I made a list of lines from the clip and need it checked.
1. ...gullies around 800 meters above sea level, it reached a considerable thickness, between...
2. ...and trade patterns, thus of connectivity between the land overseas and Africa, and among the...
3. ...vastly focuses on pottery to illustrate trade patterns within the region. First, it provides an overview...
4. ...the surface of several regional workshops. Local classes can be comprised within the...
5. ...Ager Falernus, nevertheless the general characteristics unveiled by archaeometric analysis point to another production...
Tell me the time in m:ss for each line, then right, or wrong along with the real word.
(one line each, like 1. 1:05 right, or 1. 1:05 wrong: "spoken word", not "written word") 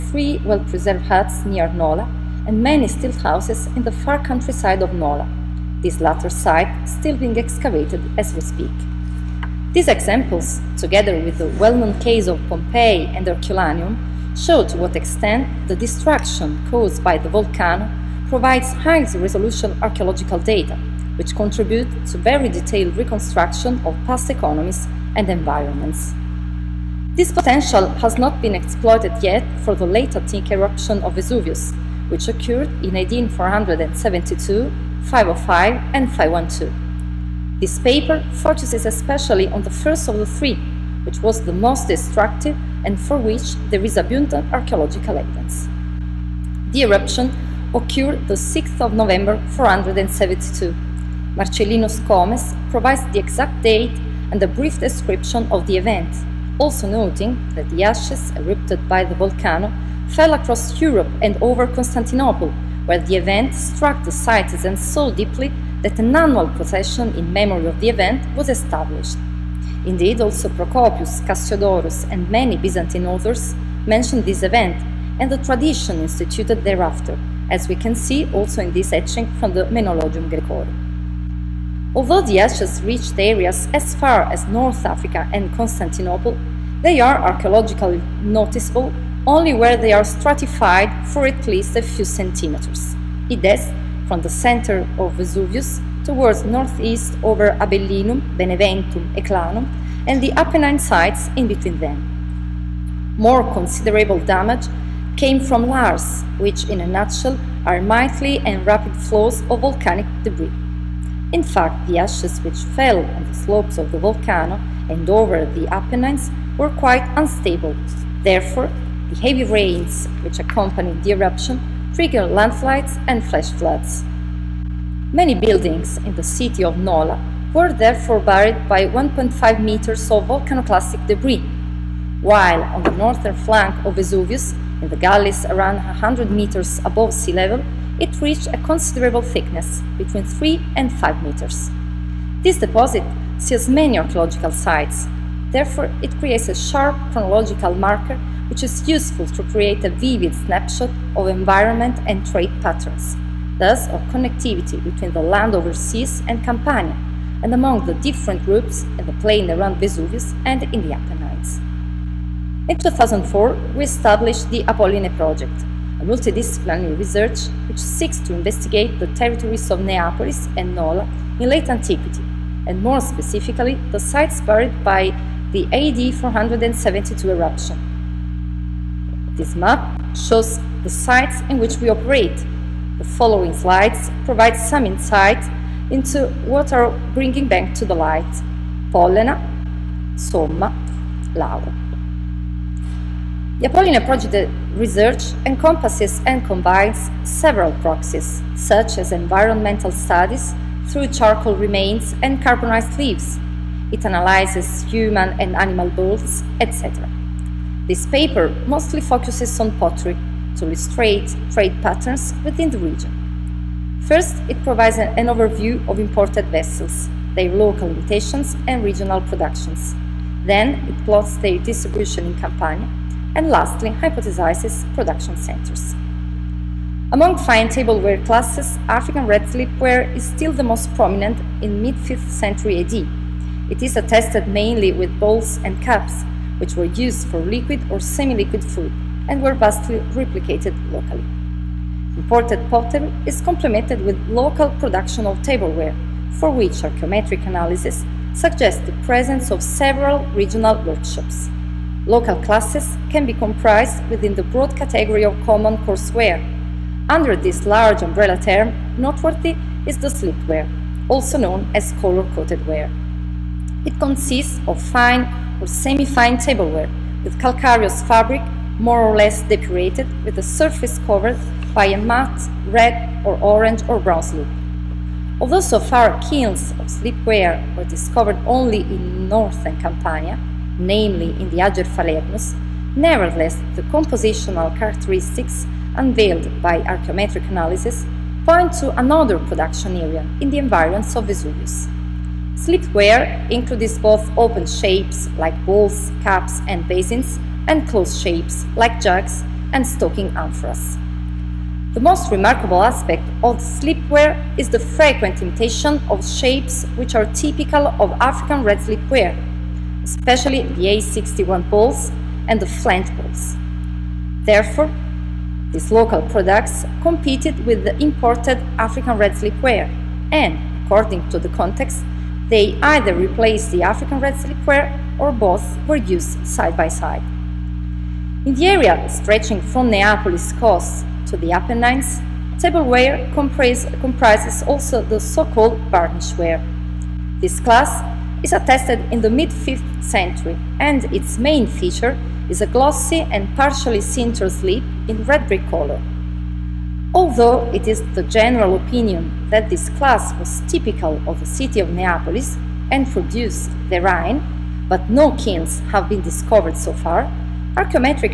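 1. 2:14 wrong: "100", not "800"
2. 2:32 wrong: "Campania", not "Africa"
3. 3:28 wrong: "mostly", not "vastly"
4. 4:08 wrong: "presence", not "surface"
5. 4:41 wrong: "compositional", not "general".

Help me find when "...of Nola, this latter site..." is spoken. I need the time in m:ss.
0:04.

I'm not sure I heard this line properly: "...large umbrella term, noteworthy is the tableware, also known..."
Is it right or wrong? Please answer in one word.
wrong.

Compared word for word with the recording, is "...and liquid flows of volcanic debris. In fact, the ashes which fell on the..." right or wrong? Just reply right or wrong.
wrong.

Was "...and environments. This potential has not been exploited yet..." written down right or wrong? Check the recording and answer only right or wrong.
right.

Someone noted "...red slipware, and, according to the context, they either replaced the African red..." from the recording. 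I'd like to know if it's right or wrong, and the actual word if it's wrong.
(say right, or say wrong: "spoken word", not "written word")
right.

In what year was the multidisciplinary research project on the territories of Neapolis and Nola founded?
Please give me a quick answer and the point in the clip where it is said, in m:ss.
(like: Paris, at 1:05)
2004, at 2:42.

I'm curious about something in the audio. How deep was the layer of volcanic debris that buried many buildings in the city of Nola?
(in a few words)
1.5 meters.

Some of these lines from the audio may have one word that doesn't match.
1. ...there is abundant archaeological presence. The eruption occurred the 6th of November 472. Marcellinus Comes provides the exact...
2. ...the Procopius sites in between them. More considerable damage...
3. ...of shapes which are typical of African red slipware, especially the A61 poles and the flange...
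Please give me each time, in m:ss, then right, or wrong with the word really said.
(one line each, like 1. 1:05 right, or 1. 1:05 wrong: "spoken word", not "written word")
1. 0:43 wrong: "evidence", not "presence"
2. 1:40 wrong: "Apennine", not "Procopius"
3. 5:06 right.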